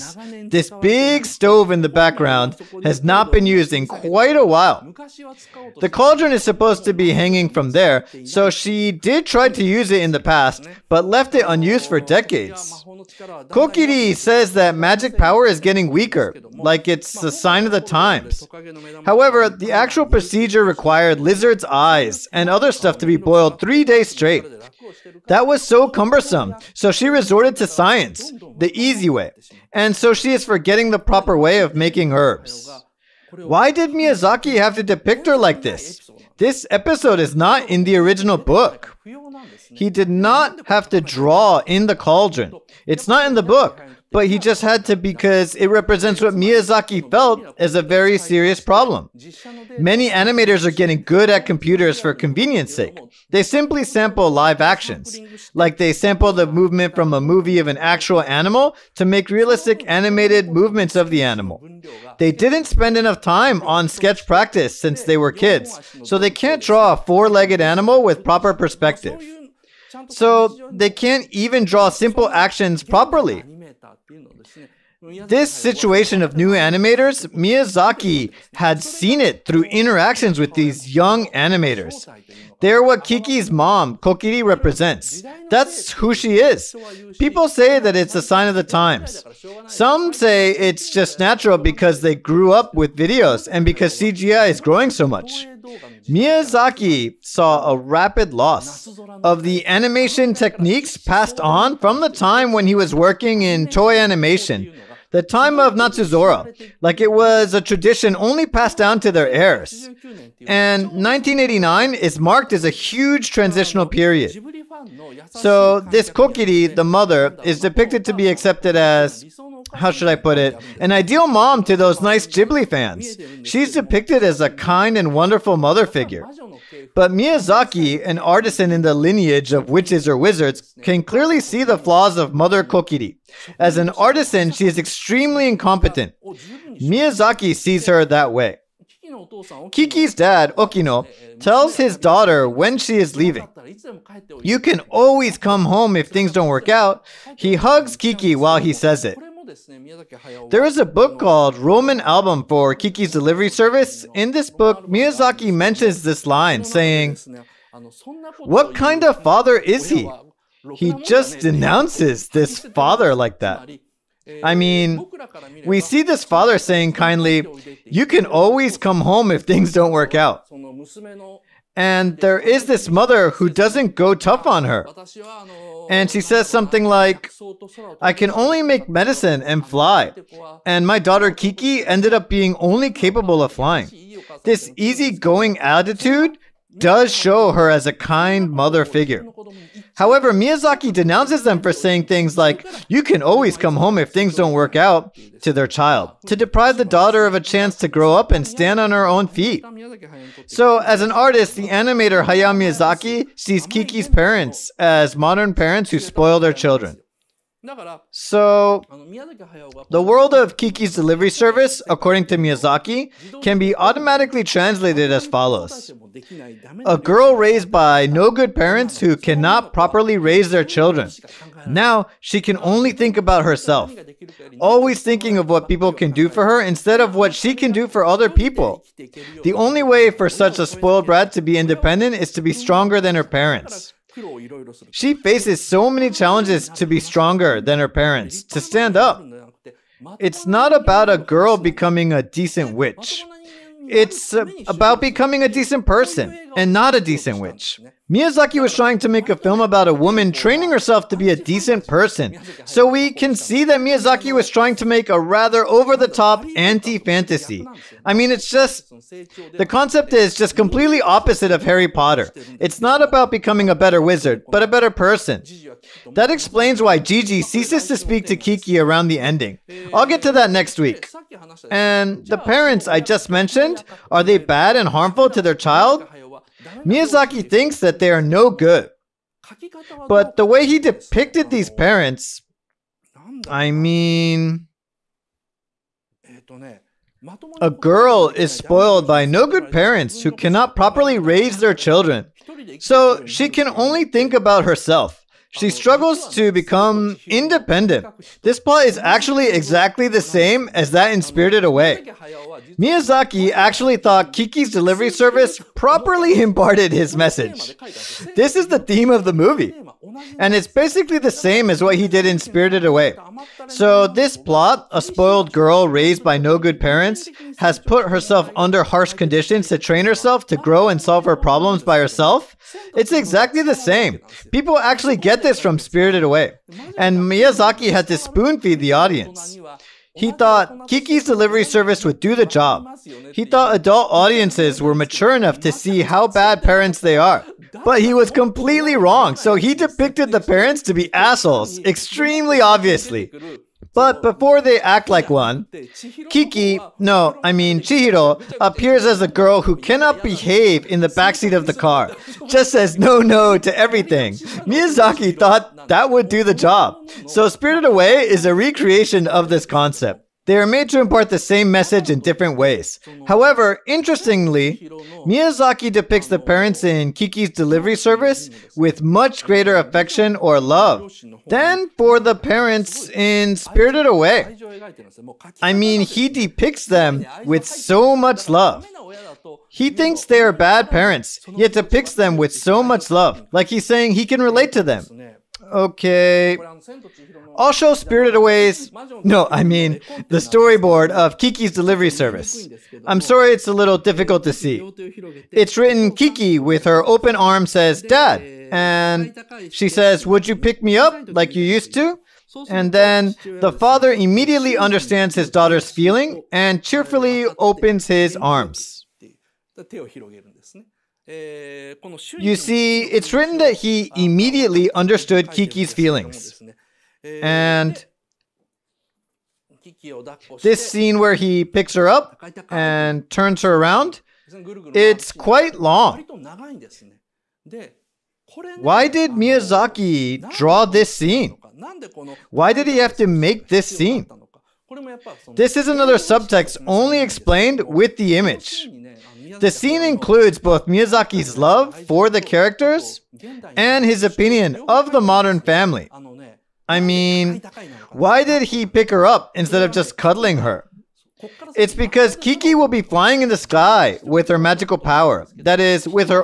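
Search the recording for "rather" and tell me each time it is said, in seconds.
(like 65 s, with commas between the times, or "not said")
255 s.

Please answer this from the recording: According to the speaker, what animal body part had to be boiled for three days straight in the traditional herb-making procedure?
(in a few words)
Lizard's eyes.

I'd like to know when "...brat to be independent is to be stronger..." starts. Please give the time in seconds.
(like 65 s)
231 s.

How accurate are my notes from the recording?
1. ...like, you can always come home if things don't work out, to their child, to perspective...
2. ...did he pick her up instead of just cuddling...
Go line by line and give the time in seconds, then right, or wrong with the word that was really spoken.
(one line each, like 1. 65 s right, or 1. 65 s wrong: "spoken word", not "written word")
1. 192 s wrong: "deprive", not "perspective"
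2. 448 s right.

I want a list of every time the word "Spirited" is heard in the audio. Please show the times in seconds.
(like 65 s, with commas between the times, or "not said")
301 s, 312 s, 325 s, 357 s, 373 s, 387 s.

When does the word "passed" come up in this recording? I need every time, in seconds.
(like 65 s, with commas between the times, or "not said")
100 s, 108 s.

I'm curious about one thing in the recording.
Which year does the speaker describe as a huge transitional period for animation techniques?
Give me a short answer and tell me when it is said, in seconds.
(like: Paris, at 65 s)
1989, at 110 s.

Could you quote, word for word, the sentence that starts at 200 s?
So, as an artist, the animator Hayao Miyazaki sees Kiki's parents as modern parents who spoil their children.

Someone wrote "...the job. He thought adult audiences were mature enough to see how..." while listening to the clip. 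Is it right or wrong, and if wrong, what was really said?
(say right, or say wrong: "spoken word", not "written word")
right.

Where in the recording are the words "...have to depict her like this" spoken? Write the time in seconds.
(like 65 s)
34 s.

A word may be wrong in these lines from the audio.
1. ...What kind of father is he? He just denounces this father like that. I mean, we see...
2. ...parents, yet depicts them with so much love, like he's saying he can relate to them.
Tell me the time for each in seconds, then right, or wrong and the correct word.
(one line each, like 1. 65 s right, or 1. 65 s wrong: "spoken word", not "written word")
1. 158 s right
2. 380 s right.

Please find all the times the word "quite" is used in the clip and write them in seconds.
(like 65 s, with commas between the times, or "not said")
3 s, 425 s.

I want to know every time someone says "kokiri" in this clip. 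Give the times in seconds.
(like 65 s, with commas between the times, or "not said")
13 s, 83 s, 116 s, 132 s.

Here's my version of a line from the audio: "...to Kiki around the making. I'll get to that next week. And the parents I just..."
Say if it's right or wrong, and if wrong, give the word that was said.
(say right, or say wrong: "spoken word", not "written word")
wrong: "ending", not "making".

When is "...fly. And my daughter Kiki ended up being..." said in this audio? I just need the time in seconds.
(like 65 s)
179 s.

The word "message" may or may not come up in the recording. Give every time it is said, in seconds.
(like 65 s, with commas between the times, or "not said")
307 s, 361 s.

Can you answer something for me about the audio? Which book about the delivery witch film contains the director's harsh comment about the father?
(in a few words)
Roman Album.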